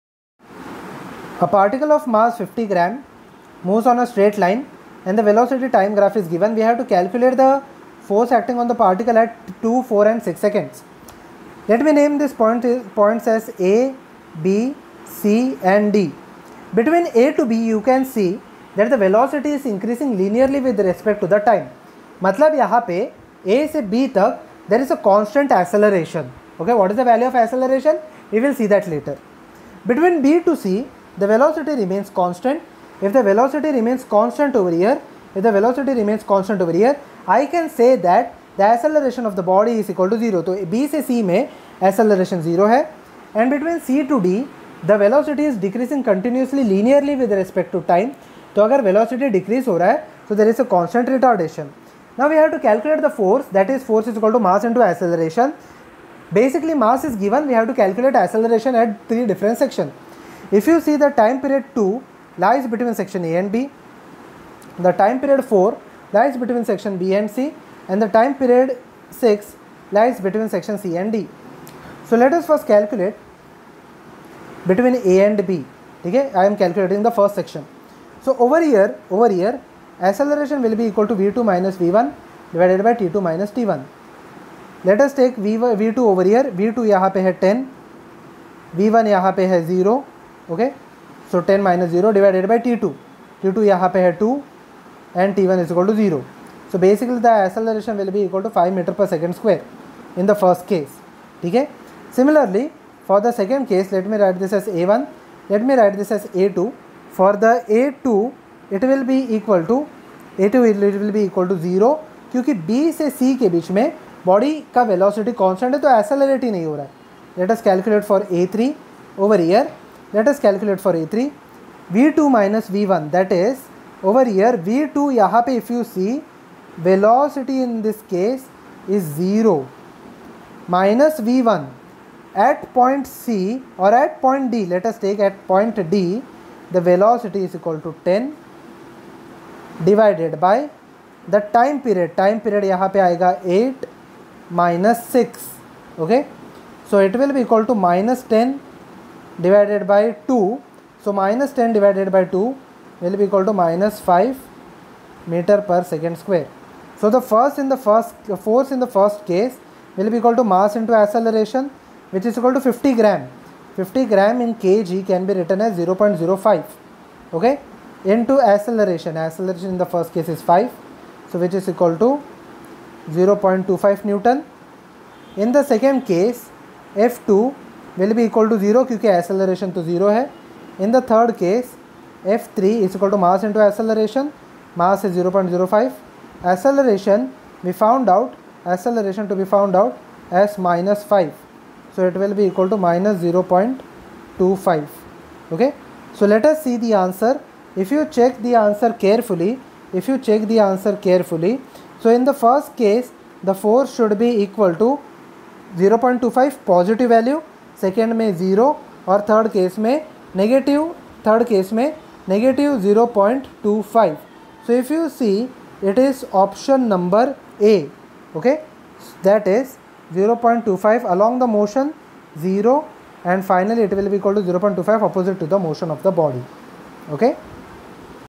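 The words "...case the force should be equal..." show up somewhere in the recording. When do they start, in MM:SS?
03:22.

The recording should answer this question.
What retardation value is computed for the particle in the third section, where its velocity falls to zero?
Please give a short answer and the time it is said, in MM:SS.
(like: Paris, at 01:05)
-5 m/s², at 02:33.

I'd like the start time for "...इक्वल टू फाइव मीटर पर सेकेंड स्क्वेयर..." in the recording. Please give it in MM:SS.
01:38.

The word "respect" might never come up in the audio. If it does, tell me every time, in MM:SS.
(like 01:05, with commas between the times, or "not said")
00:20, 00:47.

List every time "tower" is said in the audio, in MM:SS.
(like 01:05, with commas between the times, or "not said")
not said.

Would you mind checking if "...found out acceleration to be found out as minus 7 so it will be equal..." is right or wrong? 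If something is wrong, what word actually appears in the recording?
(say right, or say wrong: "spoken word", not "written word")
wrong: "5", not "7".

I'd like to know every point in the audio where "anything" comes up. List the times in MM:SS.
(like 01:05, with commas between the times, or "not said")
not said.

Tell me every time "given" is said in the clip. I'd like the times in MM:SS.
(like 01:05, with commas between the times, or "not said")
00:06, 00:57.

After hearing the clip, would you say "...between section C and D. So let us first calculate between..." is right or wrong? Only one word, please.
right.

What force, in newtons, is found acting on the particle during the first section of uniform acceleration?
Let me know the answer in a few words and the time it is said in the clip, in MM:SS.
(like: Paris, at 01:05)
0.25 newton, at 02:53.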